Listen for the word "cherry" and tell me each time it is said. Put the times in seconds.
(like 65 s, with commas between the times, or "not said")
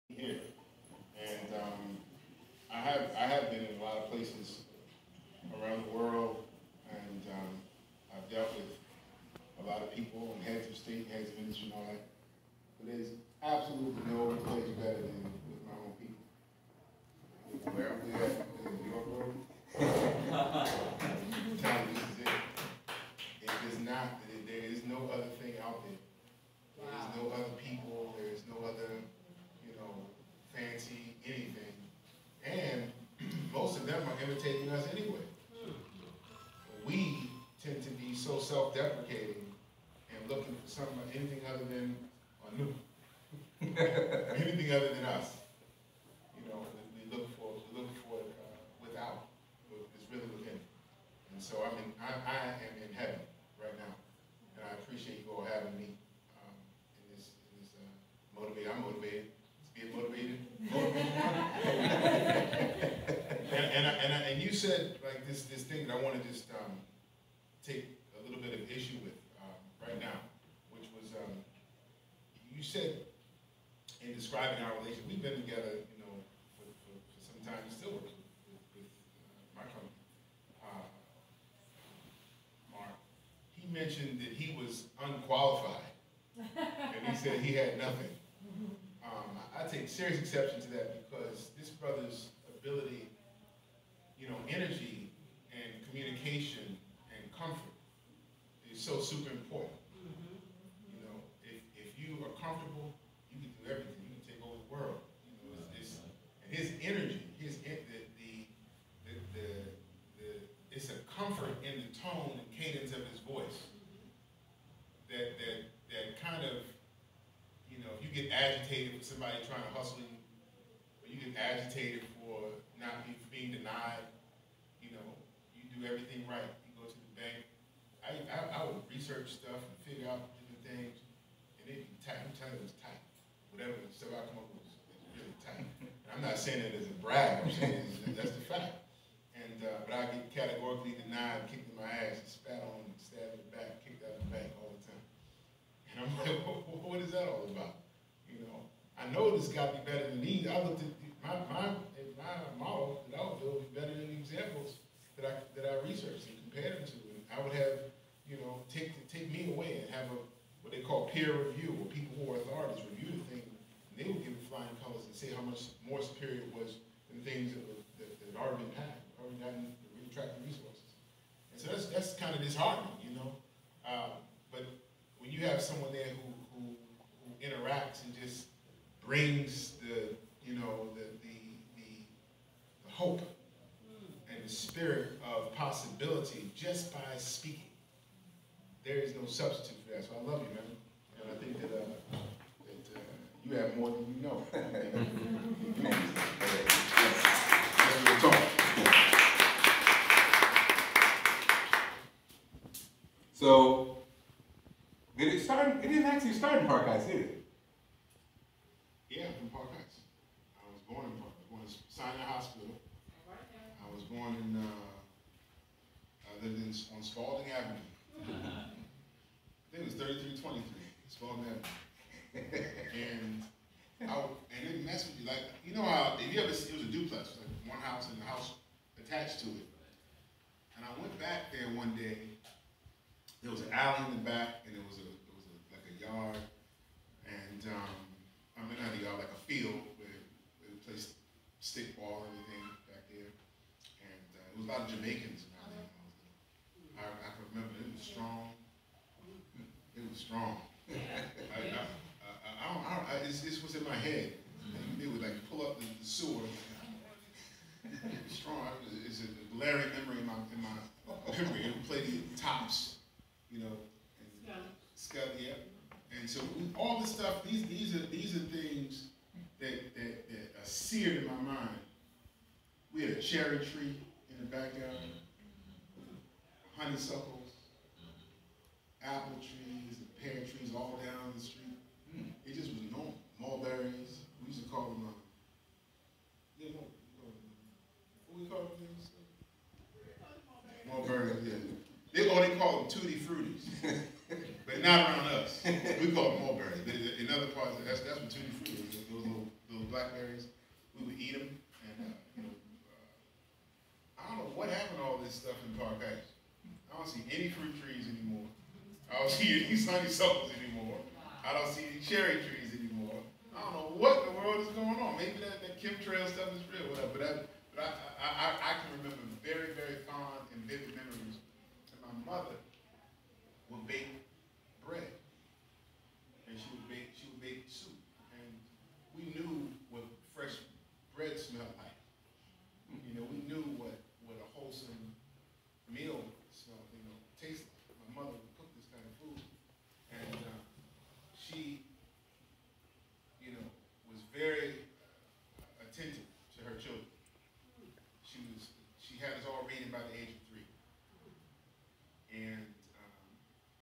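273 s, 312 s.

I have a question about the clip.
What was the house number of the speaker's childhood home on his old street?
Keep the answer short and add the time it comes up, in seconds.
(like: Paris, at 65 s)
3323, at 219 s.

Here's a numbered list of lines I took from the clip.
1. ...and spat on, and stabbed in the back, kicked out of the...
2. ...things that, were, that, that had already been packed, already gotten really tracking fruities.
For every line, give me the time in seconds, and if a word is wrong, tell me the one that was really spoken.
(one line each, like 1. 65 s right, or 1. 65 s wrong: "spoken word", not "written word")
1. 142 s right
2. 167 s wrong: "resources", not "fruities".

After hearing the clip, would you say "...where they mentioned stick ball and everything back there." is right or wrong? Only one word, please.
wrong.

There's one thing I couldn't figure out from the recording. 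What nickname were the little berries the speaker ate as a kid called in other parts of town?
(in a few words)
tutti fruities.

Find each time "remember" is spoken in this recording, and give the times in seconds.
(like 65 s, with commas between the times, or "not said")
247 s, 319 s.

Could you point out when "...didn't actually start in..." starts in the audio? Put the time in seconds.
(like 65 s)
205 s.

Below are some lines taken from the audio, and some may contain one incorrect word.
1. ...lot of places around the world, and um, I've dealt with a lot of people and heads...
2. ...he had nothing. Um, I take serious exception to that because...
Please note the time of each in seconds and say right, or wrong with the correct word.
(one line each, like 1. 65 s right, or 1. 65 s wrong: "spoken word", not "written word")
1. 3 s right
2. 87 s right.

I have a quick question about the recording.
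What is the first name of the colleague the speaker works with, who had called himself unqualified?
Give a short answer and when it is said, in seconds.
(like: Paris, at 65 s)
Mark, at 82 s.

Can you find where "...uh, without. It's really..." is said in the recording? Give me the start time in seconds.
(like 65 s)
48 s.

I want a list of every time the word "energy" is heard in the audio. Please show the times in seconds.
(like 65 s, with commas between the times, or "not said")
94 s, 106 s.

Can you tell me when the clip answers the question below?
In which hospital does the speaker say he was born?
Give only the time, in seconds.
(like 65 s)
211 s.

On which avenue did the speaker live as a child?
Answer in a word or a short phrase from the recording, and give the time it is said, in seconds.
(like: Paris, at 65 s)
Spaulding Avenue, at 217 s.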